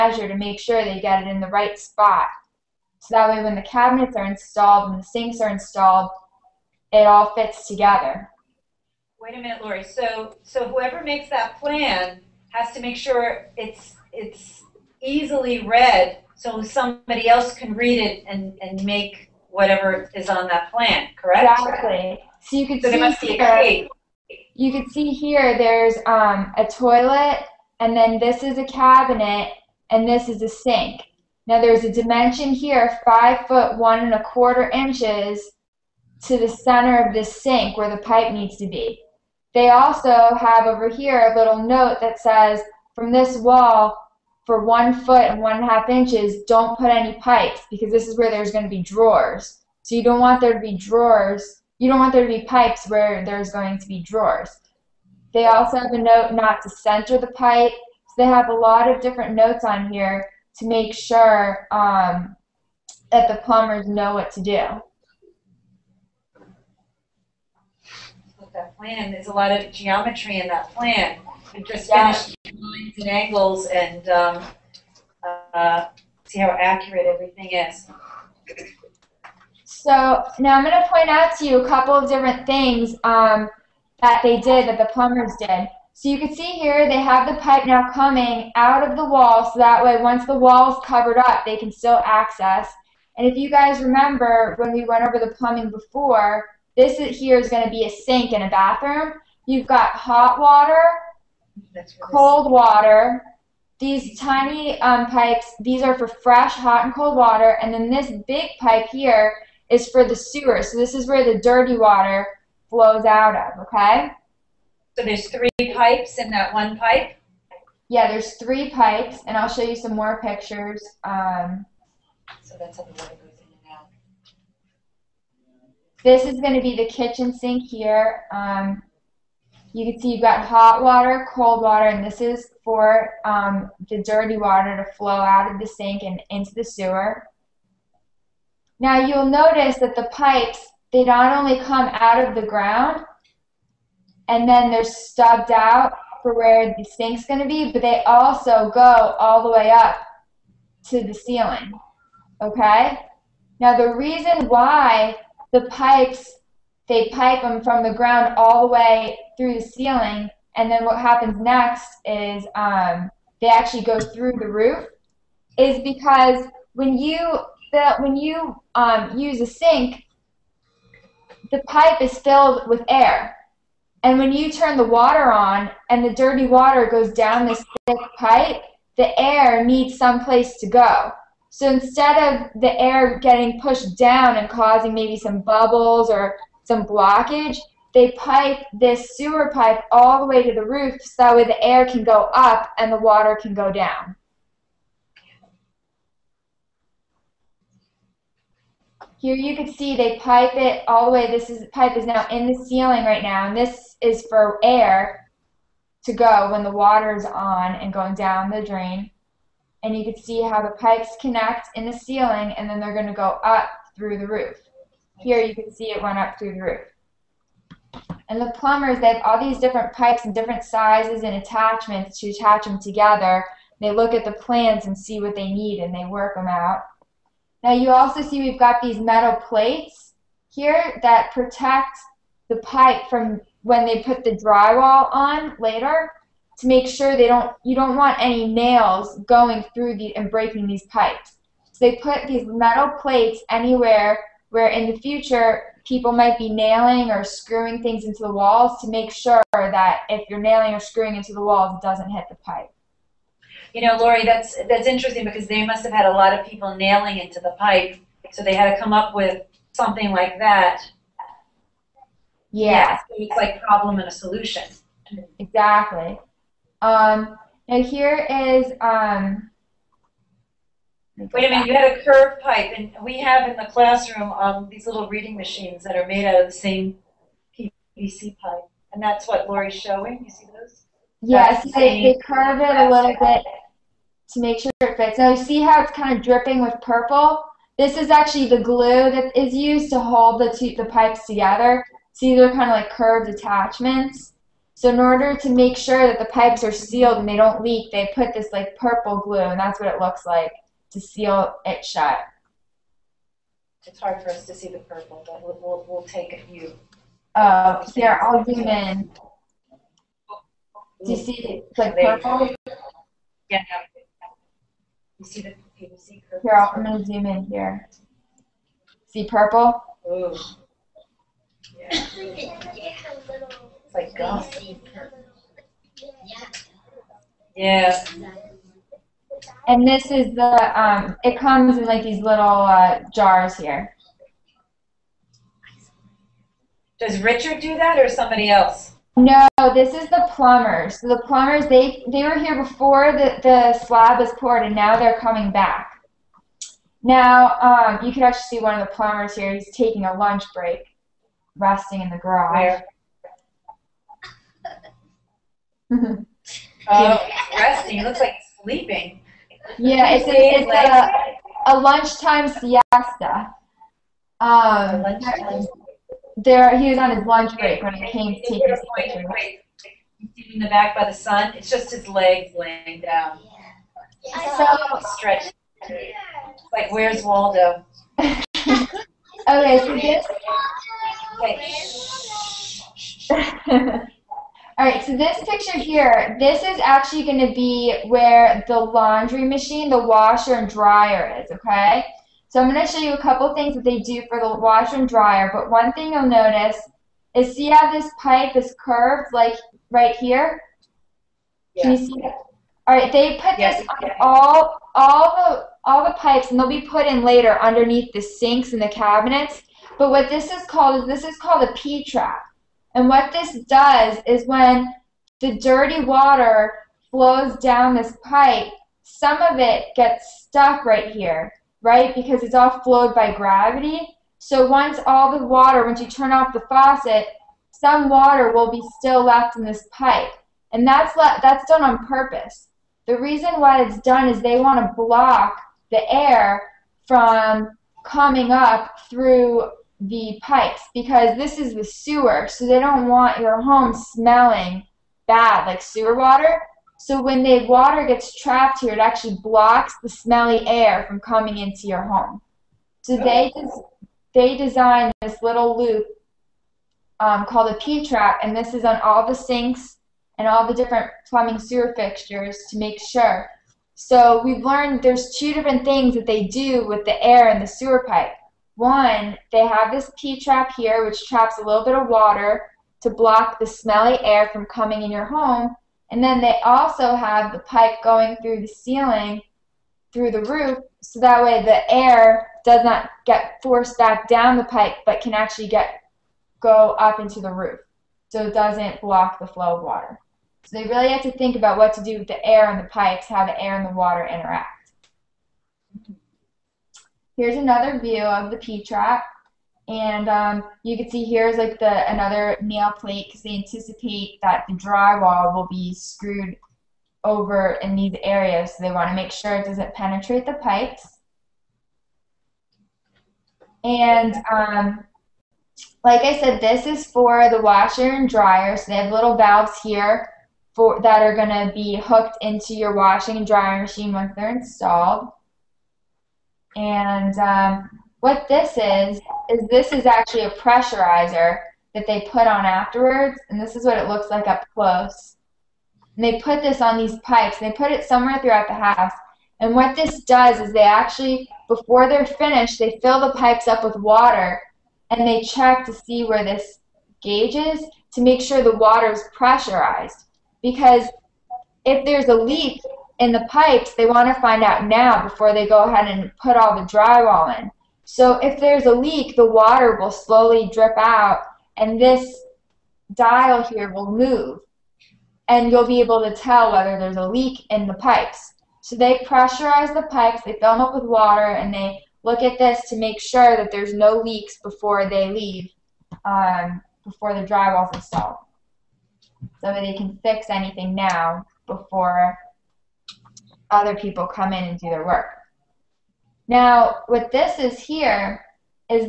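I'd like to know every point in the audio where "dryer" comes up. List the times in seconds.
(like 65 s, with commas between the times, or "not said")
390 s, 395 s, 518 s, 523 s.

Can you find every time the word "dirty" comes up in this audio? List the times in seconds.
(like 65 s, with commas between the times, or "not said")
111 s, 134 s, 176 s, 415 s.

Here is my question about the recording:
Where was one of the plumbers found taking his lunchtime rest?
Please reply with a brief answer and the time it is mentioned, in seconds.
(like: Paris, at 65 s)
the garage, at 352 s.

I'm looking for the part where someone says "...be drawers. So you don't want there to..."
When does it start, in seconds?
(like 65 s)
48 s.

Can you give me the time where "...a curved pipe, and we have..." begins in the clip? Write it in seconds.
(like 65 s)
271 s.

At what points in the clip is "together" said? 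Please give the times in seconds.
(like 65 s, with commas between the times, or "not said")
7 s, 222 s, 291 s.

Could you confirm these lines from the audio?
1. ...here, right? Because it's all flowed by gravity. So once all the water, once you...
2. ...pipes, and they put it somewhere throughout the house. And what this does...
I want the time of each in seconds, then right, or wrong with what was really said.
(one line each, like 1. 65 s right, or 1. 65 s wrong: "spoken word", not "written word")
1. 421 s right
2. 537 s right.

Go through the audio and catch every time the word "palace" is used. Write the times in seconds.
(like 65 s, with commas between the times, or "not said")
not said.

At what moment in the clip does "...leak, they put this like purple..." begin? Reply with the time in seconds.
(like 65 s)
297 s.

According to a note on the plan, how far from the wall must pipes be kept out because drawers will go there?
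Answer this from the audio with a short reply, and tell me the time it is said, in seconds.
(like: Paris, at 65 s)
1 foot 1 1/2 inches, at 44 s.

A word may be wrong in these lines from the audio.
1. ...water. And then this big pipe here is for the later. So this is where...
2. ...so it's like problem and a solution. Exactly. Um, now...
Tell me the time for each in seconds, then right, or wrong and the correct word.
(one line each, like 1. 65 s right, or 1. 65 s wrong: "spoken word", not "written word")
1. 107 s wrong: "sewer", not "later"
2. 262 s right.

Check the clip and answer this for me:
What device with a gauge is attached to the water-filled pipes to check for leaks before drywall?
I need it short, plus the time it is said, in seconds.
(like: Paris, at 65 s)
a pressurizer, at 530 s.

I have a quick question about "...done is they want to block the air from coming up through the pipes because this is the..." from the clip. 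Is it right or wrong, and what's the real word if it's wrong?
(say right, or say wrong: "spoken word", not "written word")
right.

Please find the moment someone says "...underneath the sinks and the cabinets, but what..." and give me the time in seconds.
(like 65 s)
407 s.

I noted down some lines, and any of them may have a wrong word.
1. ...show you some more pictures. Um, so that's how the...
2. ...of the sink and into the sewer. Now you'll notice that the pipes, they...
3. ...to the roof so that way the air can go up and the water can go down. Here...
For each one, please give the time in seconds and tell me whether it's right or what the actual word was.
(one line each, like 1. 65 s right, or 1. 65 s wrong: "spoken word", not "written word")
1. 119 s right
2. 135 s right
3. 190 s right.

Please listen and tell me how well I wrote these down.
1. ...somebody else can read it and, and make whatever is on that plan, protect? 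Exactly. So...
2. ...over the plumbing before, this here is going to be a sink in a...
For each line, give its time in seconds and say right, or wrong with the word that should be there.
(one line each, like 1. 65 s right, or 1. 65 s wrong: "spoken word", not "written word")
1. 16 s wrong: "correct", not "protect"
2. 95 s right.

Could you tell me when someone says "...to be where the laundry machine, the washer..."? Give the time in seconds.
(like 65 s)
387 s.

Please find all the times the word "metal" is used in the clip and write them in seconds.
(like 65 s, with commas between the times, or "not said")
228 s, 242 s.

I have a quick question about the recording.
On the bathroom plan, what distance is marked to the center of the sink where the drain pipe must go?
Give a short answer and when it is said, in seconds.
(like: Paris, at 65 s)
5 foot 1 1/4 inches, at 33 s.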